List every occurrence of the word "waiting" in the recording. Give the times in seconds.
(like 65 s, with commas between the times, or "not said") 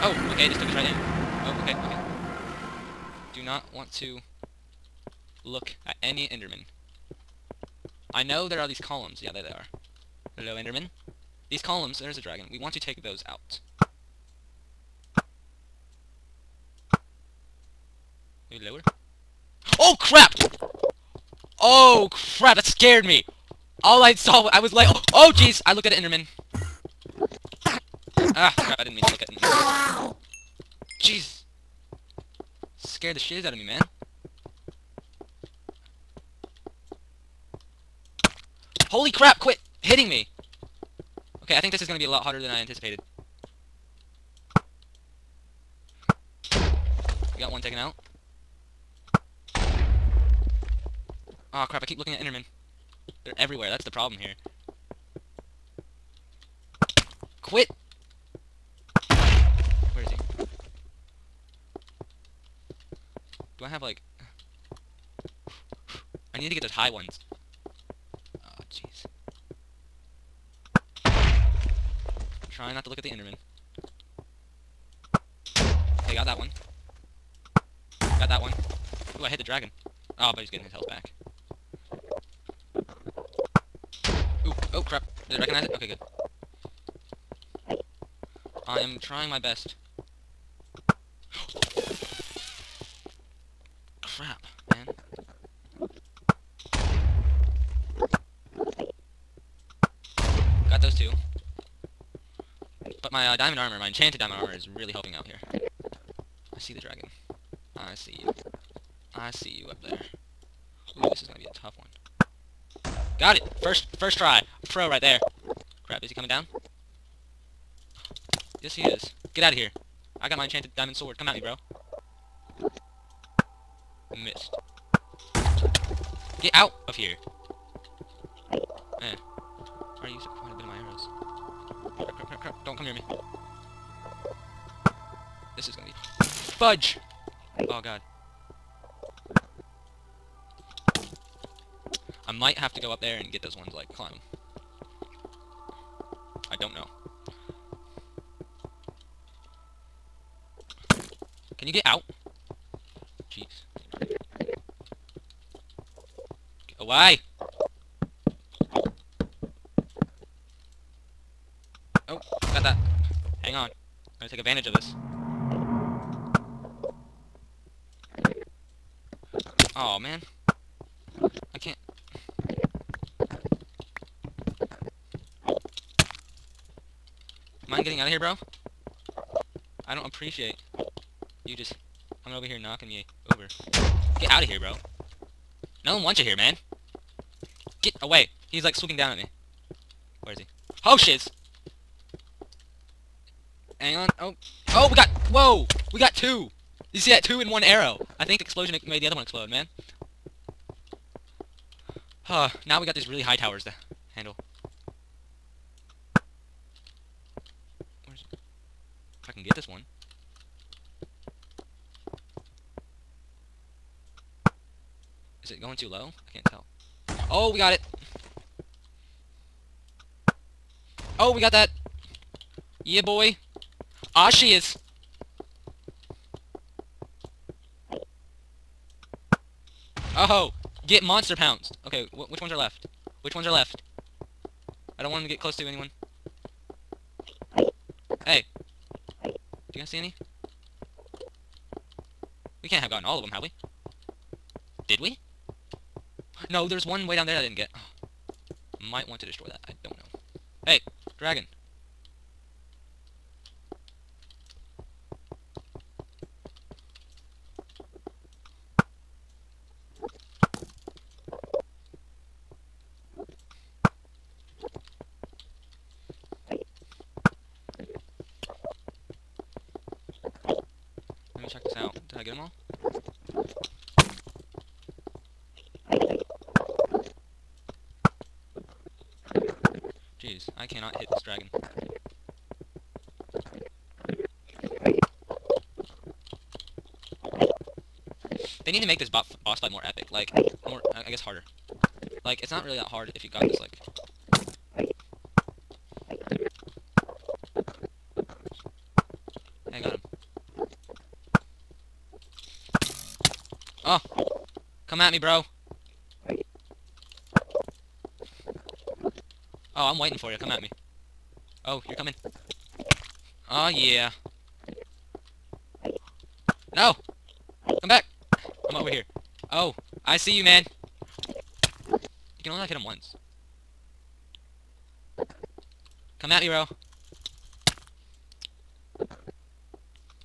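309 s.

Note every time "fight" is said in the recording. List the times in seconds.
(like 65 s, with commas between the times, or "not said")
289 s.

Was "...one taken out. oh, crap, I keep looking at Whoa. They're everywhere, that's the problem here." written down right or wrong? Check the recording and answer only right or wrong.
wrong.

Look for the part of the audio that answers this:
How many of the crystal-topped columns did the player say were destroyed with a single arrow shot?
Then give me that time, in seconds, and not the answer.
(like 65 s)
197 s.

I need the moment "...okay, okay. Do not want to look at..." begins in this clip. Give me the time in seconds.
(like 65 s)
1 s.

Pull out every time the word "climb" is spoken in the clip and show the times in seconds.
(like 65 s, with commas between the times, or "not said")
143 s.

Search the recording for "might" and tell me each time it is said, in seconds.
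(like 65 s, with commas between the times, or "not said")
142 s, 248 s.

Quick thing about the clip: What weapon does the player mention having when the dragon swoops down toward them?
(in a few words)
enchanted diamond sword.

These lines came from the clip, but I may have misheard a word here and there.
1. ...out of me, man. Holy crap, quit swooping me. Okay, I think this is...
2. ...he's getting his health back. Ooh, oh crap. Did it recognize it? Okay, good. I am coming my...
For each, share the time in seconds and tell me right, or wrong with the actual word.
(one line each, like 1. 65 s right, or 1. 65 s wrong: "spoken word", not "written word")
1. 33 s wrong: "hitting", not "swooping"
2. 80 s wrong: "trying", not "coming".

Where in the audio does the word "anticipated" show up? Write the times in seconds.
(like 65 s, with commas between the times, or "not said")
42 s.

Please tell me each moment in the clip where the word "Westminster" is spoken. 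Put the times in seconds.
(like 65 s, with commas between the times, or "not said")
not said.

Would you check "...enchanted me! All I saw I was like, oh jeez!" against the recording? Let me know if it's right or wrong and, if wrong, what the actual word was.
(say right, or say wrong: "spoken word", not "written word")
wrong: "scared", not "enchanted".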